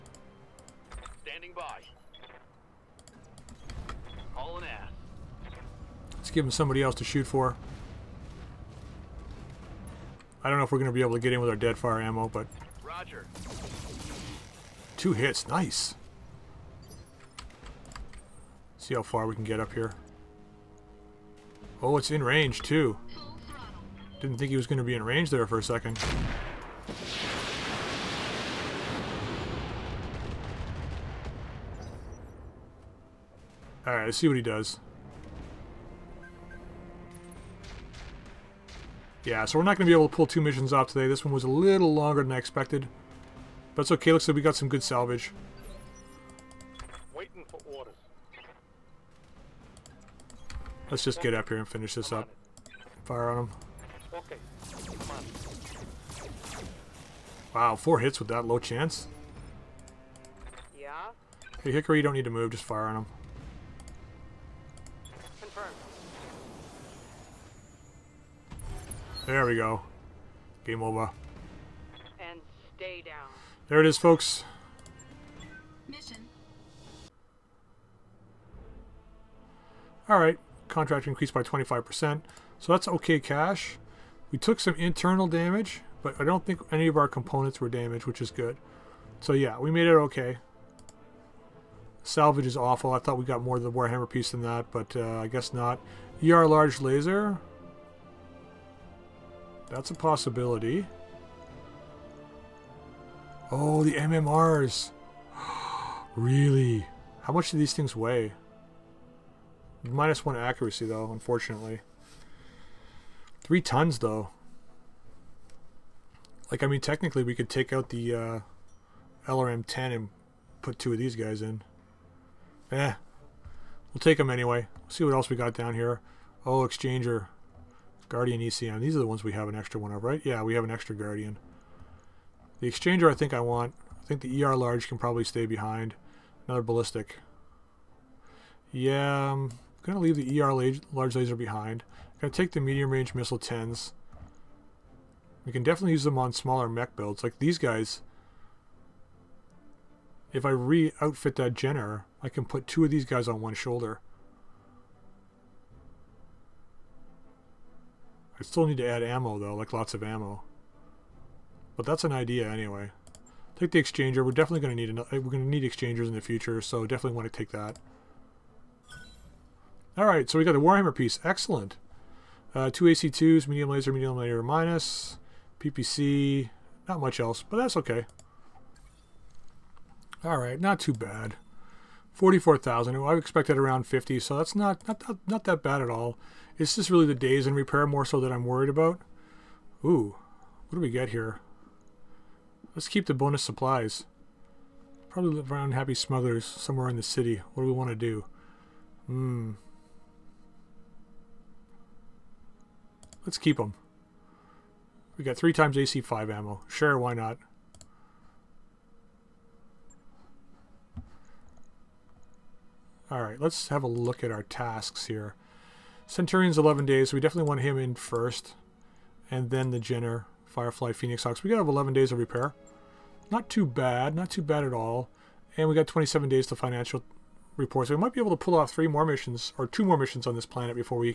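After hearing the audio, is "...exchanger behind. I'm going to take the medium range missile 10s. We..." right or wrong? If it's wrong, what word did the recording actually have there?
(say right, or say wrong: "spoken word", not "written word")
wrong: "laser", not "exchanger".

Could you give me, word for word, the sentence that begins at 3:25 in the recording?
We got three times AC5 ammo.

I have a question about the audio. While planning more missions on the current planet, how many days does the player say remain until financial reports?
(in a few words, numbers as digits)
27.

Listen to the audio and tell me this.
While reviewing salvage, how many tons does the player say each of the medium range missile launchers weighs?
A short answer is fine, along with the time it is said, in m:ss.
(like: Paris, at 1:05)
3 tons, at 1:53.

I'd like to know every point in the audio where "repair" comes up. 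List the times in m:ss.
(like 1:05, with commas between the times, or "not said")
3:07, 3:42.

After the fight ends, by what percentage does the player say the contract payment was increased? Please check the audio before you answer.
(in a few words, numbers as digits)
25%.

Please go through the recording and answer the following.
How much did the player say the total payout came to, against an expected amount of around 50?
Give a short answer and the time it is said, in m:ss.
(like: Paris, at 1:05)
44,000, at 3:02.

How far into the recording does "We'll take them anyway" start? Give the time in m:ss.
2:03.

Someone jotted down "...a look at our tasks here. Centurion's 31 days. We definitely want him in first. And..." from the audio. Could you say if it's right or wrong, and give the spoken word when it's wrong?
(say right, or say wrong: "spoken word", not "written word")
wrong: "11", not "31".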